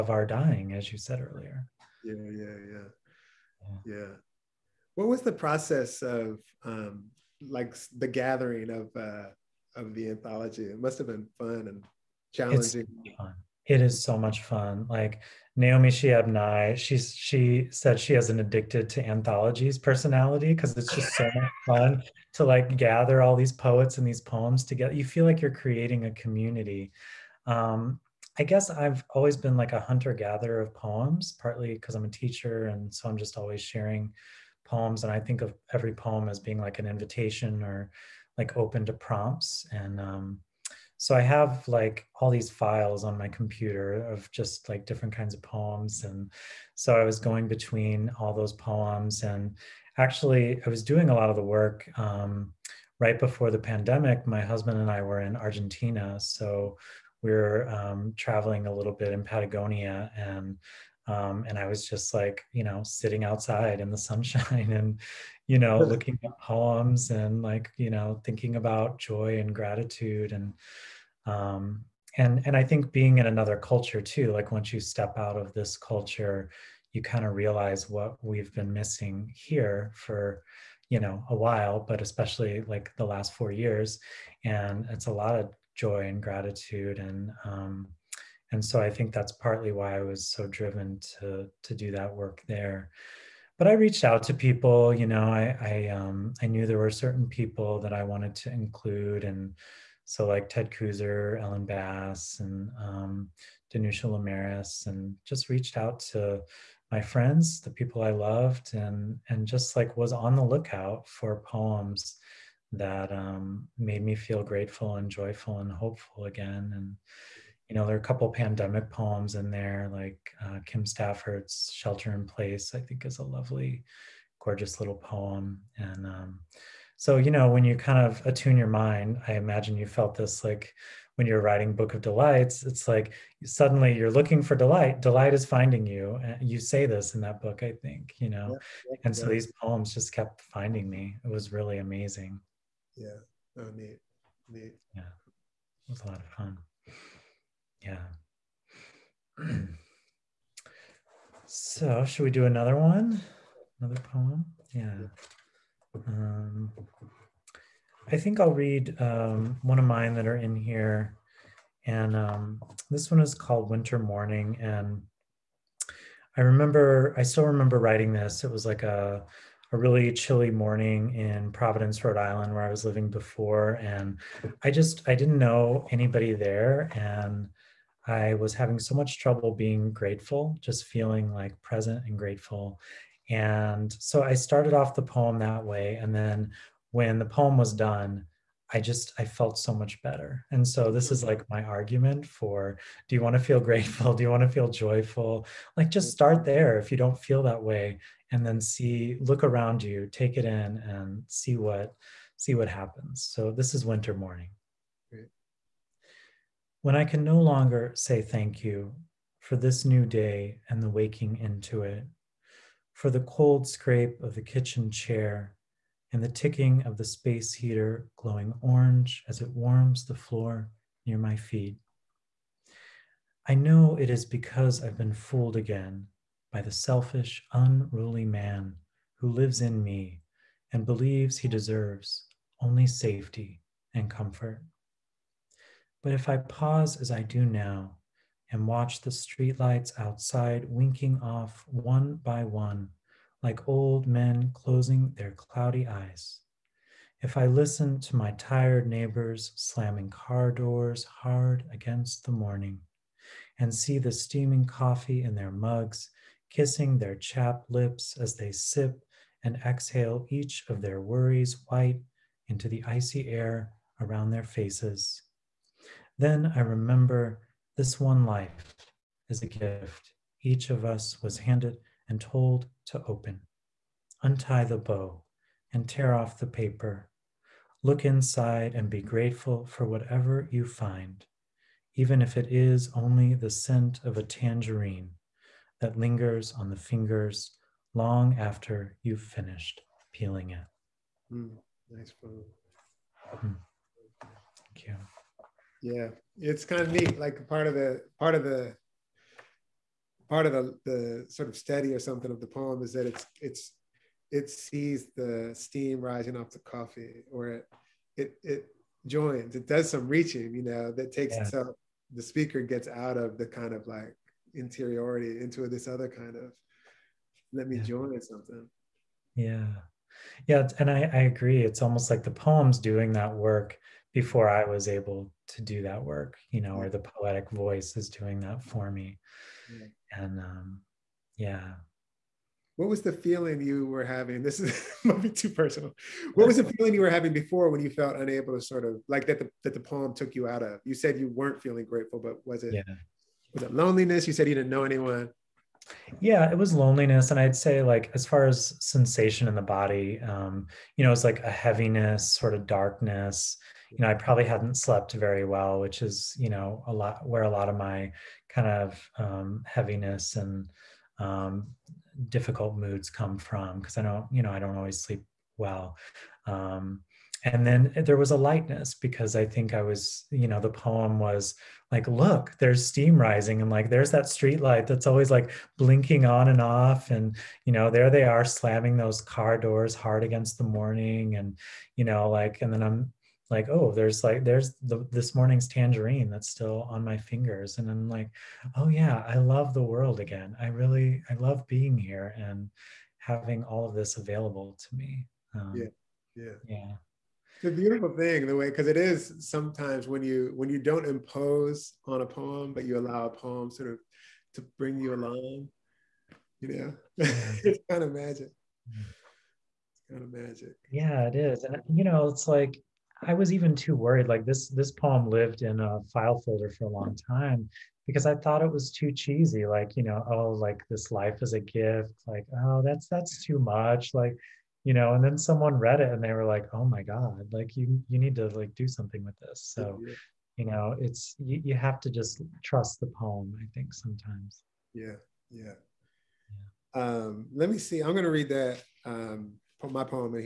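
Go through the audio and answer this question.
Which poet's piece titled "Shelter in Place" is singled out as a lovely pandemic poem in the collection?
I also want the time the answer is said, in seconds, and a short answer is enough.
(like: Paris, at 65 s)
Kim Stafford, at 120 s.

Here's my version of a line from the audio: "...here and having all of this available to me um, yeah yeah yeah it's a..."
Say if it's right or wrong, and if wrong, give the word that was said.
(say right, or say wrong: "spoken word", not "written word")
right.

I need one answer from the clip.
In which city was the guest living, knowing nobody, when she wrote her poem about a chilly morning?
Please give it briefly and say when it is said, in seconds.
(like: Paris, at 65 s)
Providence, Rhode Island, at 171 s.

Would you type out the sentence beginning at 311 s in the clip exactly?
itself the speaker gets out of the kind of like interiority into this other kind of let me yeah.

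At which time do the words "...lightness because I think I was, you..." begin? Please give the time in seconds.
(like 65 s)
368 s.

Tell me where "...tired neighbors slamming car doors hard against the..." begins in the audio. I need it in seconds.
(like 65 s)
248 s.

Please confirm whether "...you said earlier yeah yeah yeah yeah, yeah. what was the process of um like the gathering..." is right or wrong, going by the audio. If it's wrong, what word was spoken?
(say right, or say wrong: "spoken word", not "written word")
right.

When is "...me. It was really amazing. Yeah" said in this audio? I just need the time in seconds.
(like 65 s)
140 s.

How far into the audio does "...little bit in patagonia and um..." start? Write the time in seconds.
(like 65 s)
58 s.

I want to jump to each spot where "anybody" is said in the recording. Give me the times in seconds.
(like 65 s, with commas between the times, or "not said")
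175 s.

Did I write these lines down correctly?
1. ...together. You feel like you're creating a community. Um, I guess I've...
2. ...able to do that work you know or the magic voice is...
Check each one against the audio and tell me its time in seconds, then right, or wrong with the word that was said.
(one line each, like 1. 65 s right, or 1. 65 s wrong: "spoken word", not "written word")
1. 24 s right
2. 324 s wrong: "poetic", not "magic".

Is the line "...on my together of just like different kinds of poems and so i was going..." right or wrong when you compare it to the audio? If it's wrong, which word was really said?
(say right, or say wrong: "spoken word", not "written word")
wrong: "computer", not "together".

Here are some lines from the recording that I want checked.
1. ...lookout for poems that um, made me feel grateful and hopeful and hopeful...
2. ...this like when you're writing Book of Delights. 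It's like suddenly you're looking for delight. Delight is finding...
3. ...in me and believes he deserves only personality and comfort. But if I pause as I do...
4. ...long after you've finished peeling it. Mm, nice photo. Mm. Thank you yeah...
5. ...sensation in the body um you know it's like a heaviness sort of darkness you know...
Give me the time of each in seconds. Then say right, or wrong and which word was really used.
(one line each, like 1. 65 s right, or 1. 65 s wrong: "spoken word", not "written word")
1. 110 s wrong: "joyful", not "hopeful"
2. 130 s right
3. 229 s wrong: "safety", not "personality"
4. 287 s right
5. 348 s right.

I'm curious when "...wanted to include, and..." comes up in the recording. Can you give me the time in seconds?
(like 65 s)
98 s.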